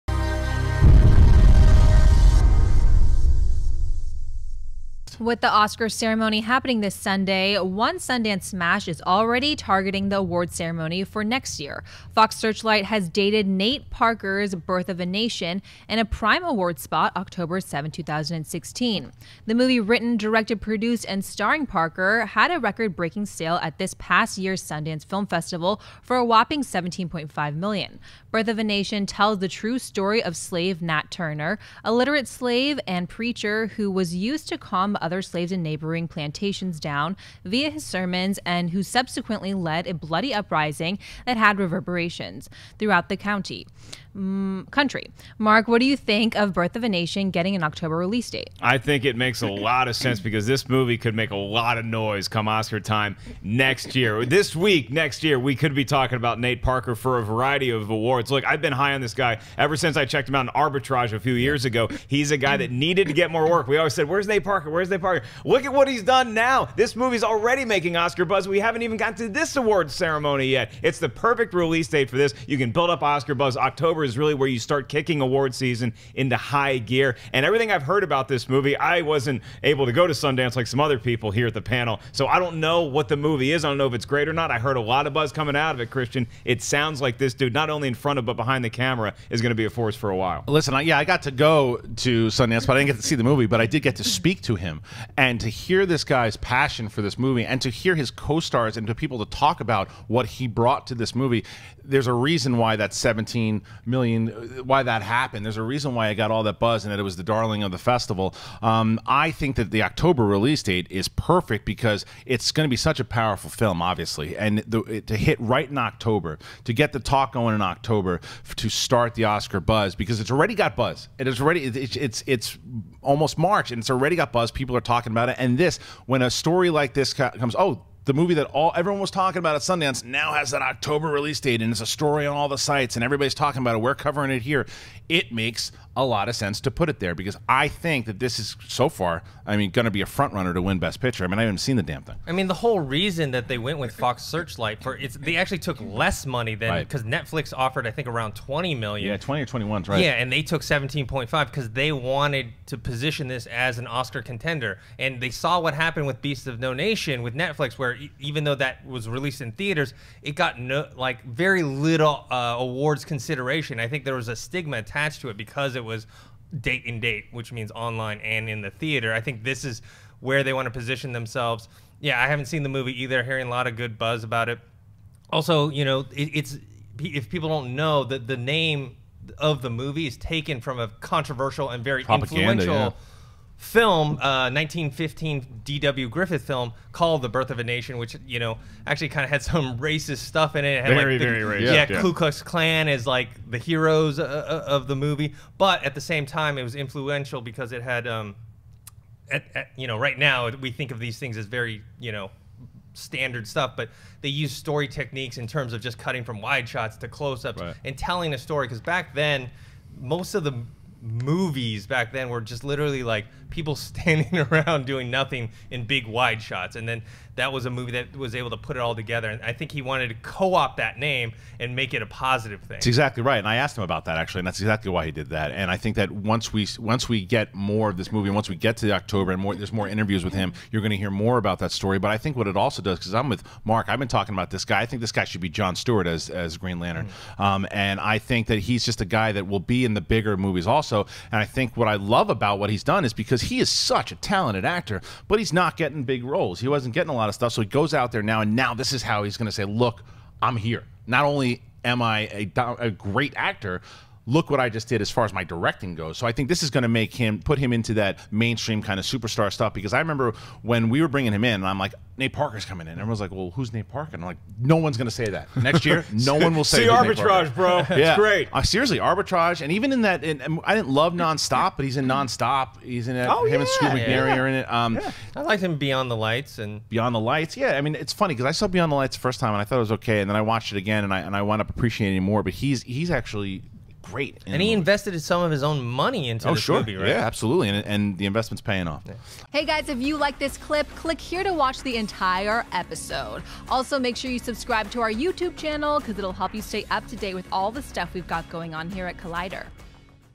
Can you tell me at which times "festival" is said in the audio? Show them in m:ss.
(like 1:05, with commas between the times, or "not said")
0:25, 1:47.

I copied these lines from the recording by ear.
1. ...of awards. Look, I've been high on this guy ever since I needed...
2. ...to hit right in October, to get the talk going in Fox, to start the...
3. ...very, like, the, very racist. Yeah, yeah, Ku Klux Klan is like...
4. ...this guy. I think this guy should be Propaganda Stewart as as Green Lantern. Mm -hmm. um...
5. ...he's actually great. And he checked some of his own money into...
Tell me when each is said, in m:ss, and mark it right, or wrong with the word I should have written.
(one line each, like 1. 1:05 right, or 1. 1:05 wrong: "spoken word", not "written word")
1. 0:57 wrong: "checked", not "needed"
2. 1:55 wrong: "October", not "Fox"
3. 3:10 right
4. 3:54 wrong: "John", not "Propaganda"
5. 4:42 wrong: "invested", not "checked".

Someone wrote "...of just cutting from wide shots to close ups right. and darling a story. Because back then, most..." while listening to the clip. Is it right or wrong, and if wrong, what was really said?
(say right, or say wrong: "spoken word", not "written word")
wrong: "telling", not "darling".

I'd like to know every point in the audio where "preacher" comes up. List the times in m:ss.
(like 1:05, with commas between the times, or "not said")
0:33.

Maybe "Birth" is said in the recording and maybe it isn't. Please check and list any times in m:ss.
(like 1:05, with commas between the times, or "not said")
0:14, 0:28, 0:46, 3:07.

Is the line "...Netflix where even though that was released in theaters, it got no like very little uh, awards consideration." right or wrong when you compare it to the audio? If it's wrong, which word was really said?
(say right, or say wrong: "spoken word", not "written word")
right.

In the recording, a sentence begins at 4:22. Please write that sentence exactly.
Everyone's like, well, who's Nate Parker?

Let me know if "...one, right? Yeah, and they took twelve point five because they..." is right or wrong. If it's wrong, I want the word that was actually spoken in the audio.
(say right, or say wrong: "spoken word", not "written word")
wrong: "seventeen", not "twelve".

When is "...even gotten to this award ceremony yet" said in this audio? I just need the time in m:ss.
1:08.